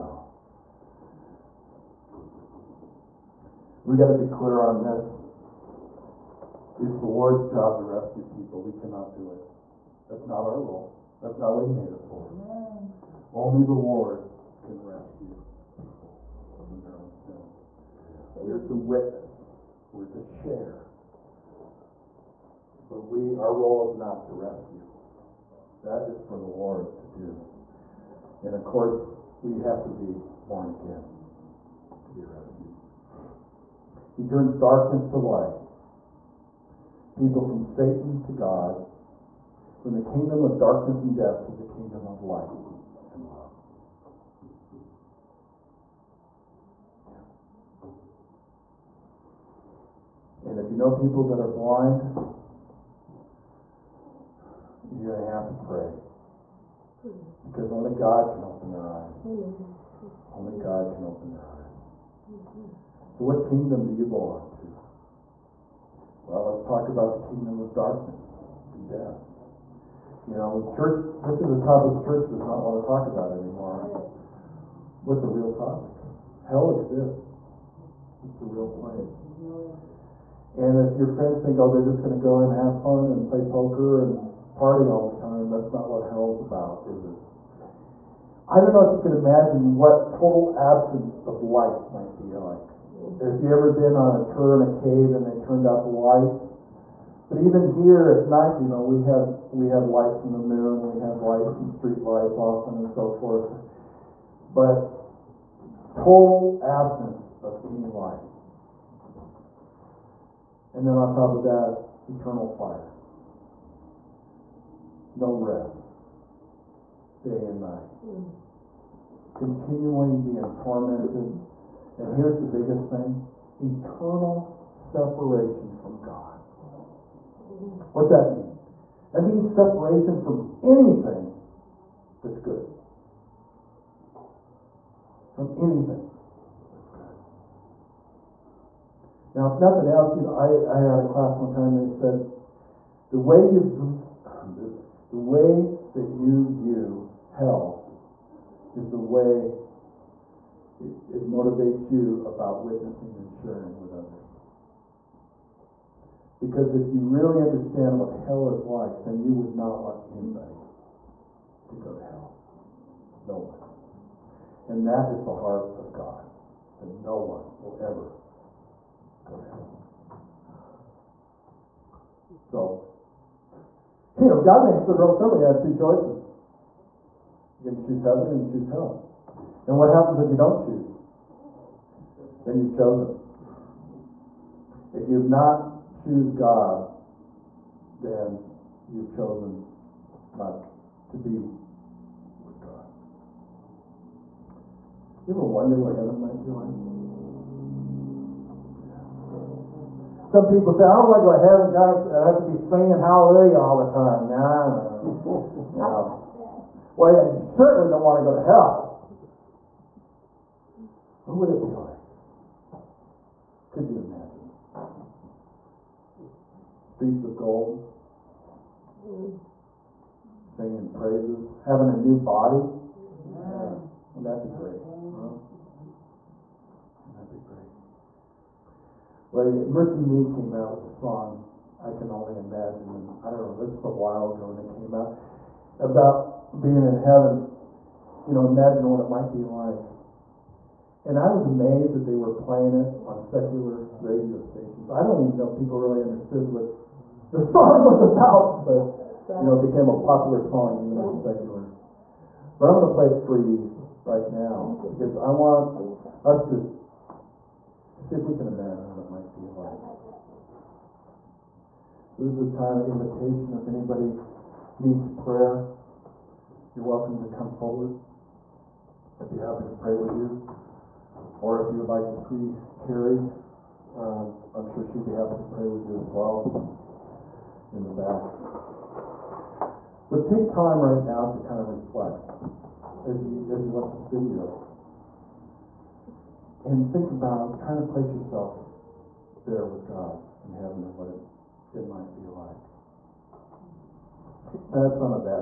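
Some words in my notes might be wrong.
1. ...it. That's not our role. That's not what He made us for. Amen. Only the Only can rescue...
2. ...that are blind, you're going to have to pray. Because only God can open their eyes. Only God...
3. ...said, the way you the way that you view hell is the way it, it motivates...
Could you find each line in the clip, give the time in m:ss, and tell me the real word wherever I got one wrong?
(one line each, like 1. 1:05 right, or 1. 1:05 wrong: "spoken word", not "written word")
1. 0:09 wrong: "Lord", not "Only"
2. 0:51 right
3. 2:21 right.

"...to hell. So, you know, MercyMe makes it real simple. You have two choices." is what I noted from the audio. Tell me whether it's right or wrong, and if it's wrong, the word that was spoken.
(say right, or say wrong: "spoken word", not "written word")
wrong: "God", not "MercyMe".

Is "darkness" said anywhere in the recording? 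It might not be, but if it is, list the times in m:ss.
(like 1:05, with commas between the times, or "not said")
0:34, 0:40, 1:07.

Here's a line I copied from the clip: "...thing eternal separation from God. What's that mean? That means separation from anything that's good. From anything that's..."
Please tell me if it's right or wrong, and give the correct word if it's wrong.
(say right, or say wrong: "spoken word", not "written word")
right.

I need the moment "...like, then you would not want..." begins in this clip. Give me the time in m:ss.
2:38.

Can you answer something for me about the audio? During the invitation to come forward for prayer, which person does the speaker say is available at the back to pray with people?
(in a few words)
Carrie.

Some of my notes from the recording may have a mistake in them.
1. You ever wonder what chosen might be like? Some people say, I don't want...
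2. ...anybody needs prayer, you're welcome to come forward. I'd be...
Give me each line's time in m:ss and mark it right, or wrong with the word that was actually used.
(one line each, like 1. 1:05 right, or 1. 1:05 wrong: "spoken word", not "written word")
1. 3:15 wrong: "heaven", not "chosen"
2. 4:23 right.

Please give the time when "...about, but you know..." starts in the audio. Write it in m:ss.
4:08.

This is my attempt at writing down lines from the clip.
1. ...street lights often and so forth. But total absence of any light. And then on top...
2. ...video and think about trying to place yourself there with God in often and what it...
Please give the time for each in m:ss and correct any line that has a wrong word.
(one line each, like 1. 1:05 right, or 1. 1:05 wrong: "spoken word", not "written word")
1. 1:41 right
2. 4:44 wrong: "heaven", not "often".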